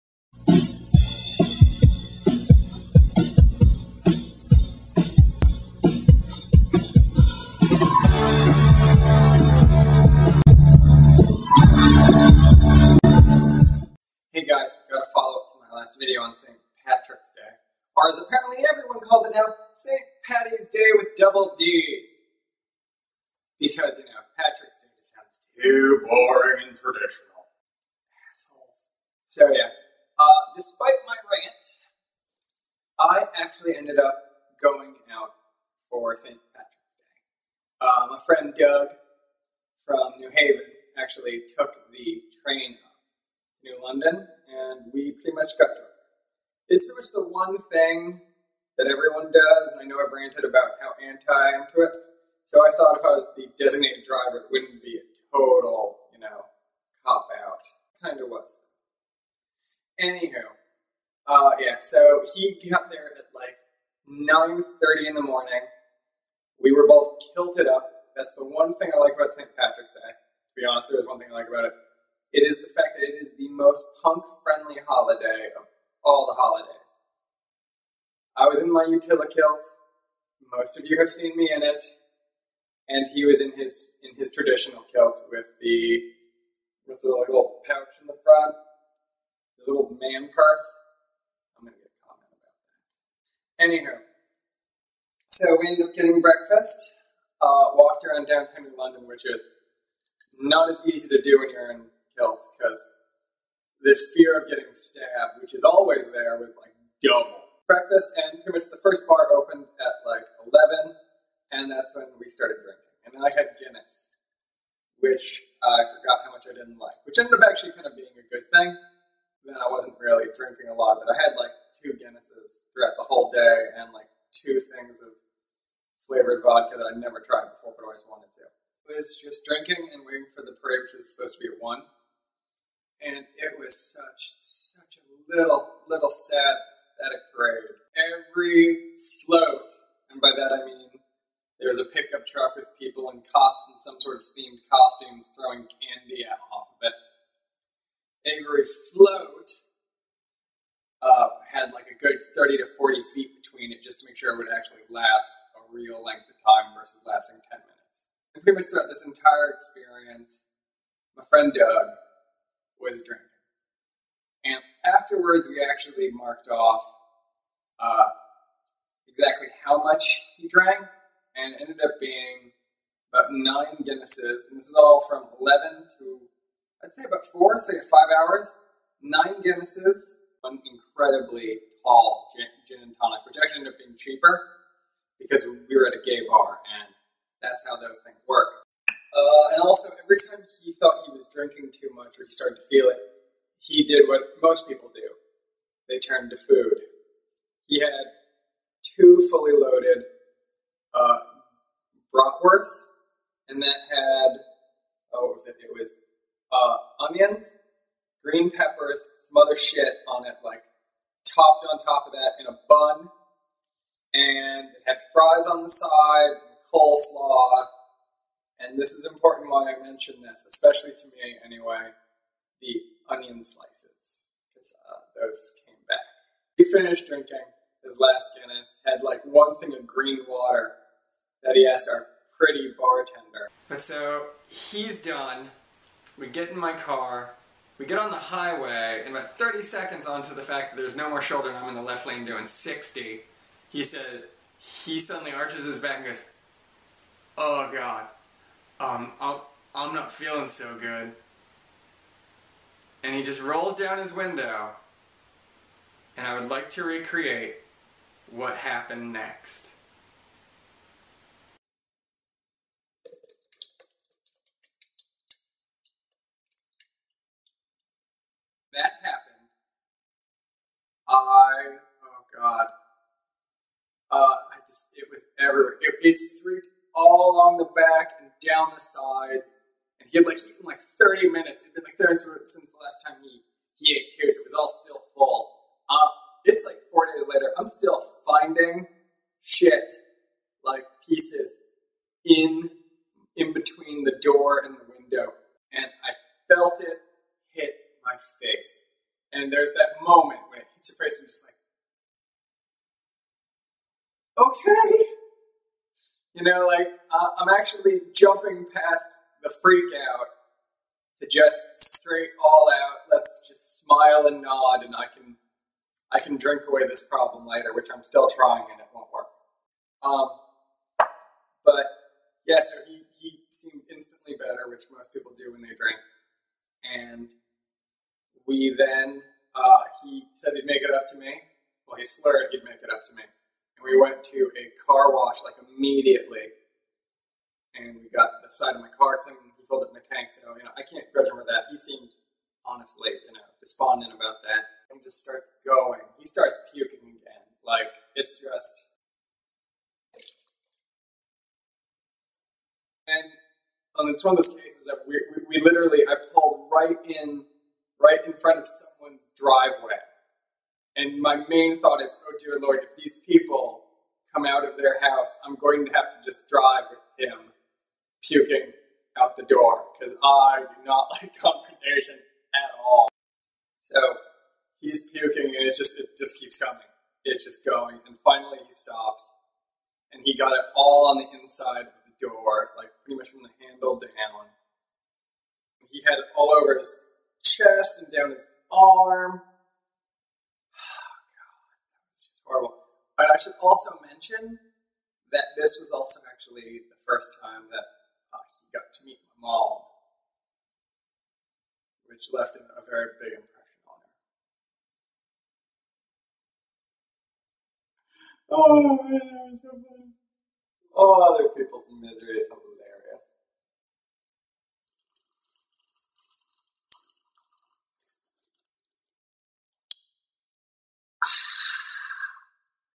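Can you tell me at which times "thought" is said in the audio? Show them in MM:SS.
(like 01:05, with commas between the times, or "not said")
00:52, 03:10, 06:01.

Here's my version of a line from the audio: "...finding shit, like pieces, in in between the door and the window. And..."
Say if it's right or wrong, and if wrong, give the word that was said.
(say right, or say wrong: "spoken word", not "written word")
right.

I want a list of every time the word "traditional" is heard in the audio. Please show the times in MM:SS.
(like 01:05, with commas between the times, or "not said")
00:26, 01:24.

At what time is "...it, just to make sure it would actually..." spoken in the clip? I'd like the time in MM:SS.
02:33.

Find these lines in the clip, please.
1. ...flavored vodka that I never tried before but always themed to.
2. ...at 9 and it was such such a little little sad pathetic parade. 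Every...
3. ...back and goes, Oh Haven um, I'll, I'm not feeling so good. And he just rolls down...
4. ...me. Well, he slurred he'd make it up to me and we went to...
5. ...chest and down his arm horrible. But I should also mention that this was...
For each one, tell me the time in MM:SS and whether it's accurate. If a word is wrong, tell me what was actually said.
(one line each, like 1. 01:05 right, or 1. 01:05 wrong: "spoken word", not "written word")
1. 02:06 wrong: "wanted", not "themed"
2. 02:11 wrong: "1", not "9"
3. 04:05 wrong: "God", not "Haven"
4. 05:31 right
5. 06:27 right.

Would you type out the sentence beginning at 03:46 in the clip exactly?
He finished drinking his last Guinness, had like one thing of green water that he asked our pretty bartender.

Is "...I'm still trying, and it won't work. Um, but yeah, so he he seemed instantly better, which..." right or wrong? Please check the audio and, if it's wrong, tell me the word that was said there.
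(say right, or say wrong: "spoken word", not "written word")
right.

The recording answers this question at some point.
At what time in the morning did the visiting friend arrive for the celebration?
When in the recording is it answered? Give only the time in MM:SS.
01:04.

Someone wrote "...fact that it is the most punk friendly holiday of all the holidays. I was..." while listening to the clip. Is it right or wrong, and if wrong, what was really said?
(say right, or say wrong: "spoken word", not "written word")
right.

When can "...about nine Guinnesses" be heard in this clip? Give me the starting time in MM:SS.
02:53.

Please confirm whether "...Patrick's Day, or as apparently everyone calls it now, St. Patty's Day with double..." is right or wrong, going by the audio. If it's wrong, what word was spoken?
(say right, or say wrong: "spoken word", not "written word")
right.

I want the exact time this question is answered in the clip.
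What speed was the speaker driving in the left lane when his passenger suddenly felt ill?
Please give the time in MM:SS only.
04:02.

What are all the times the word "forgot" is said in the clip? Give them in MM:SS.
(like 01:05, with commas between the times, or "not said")
01:55.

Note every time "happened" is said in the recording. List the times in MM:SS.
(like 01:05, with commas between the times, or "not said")
04:18, 04:29.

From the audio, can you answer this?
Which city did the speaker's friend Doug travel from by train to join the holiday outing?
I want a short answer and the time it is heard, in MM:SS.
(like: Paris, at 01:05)
New Haven, at 00:40.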